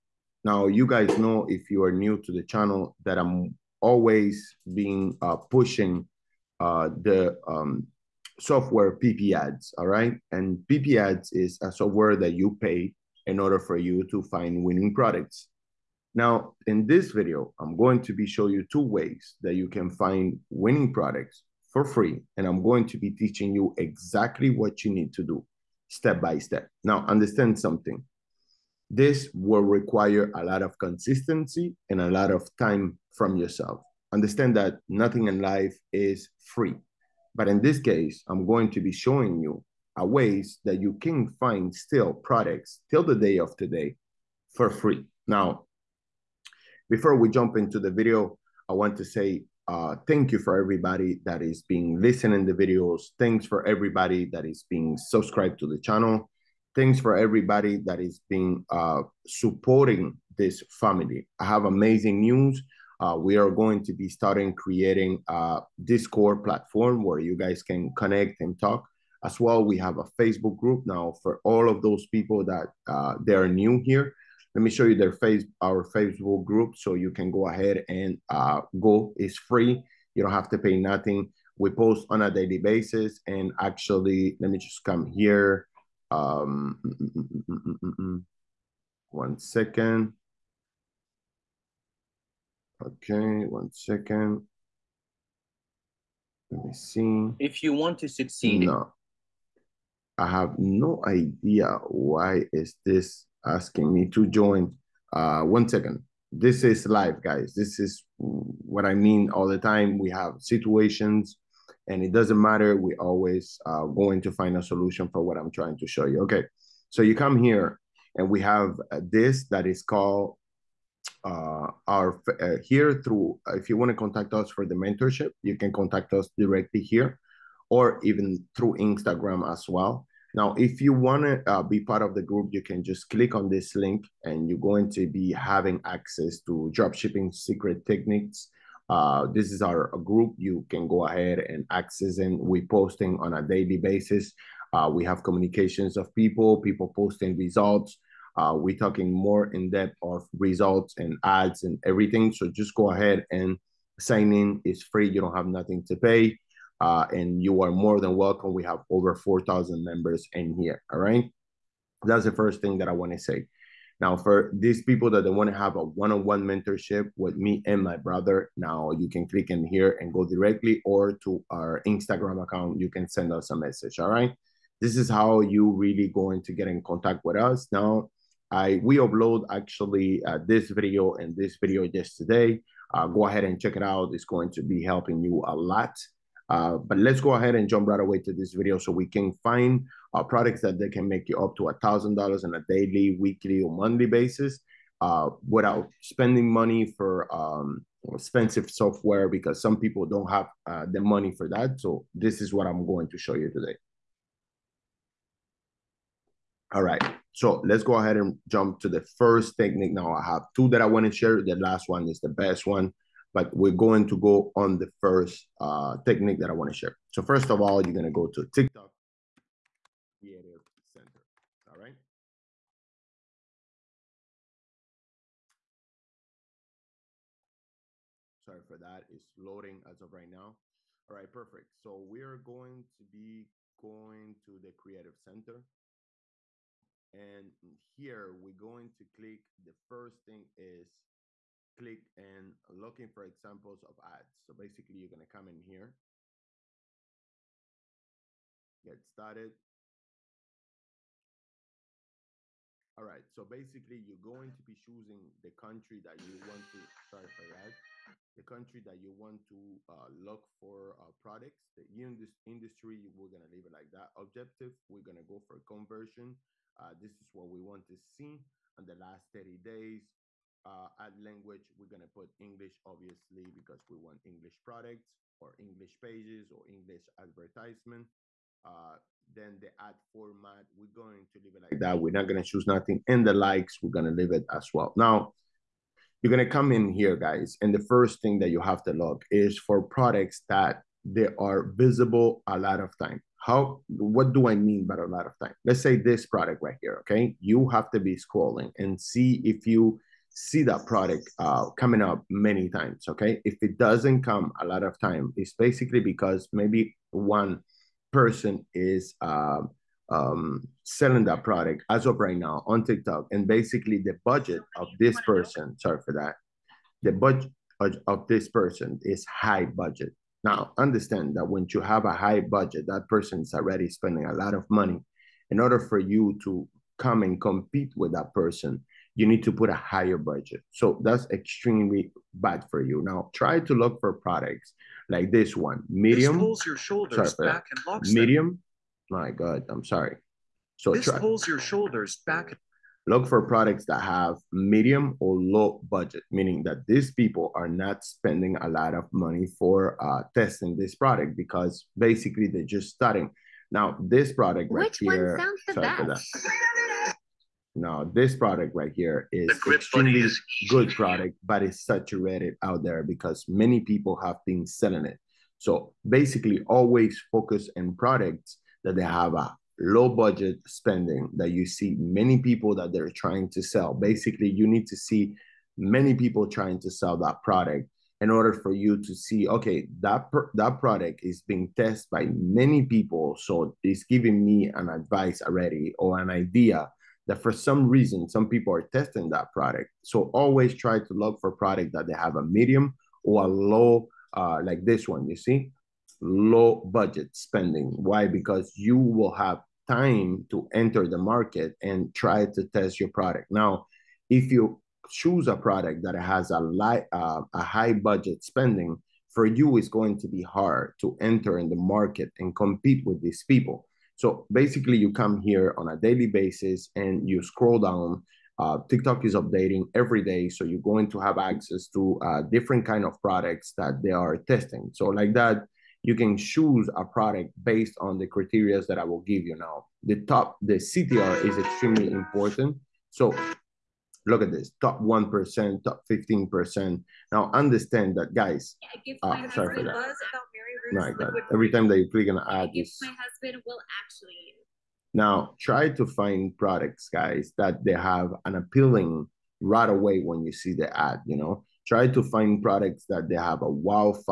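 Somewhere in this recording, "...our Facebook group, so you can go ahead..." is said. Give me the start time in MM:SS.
01:15.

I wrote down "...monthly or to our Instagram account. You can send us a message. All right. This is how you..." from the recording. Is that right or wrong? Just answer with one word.
wrong.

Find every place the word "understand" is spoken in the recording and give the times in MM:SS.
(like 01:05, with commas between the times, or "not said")
00:27, 00:34, 05:20, 07:17.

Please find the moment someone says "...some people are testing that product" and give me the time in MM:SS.
06:28.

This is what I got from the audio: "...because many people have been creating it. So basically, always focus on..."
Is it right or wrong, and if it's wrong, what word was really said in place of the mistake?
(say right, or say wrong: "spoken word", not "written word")
wrong: "selling", not "creating".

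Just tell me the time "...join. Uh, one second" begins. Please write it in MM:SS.
01:44.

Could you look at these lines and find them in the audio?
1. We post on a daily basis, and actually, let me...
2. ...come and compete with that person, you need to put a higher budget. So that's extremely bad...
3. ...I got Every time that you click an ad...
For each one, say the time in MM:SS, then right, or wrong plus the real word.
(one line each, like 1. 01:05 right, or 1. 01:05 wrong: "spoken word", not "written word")
1. 01:21 right
2. 05:26 right
3. 07:21 right.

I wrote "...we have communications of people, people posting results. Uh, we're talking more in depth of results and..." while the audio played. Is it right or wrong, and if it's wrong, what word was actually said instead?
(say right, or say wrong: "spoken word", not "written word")
right.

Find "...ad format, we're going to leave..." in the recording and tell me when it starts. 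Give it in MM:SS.
04:39.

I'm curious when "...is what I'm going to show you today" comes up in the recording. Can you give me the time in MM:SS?
03:22.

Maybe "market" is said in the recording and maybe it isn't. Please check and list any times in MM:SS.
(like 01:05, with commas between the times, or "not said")
06:41, 06:51.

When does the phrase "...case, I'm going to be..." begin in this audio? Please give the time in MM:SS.
00:37.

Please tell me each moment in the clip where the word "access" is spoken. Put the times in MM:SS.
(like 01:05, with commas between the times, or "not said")
02:15, 02:21, 07:01.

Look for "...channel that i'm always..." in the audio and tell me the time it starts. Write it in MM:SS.
00:02.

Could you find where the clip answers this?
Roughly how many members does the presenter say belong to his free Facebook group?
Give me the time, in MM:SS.
02:38.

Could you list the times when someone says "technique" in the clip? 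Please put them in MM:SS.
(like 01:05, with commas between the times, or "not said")
02:17, 03:29, 03:36.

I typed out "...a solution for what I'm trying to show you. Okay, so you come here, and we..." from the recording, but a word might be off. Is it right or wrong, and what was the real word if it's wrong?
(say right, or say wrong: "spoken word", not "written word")
right.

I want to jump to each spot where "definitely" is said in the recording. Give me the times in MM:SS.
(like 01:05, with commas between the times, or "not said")
not said.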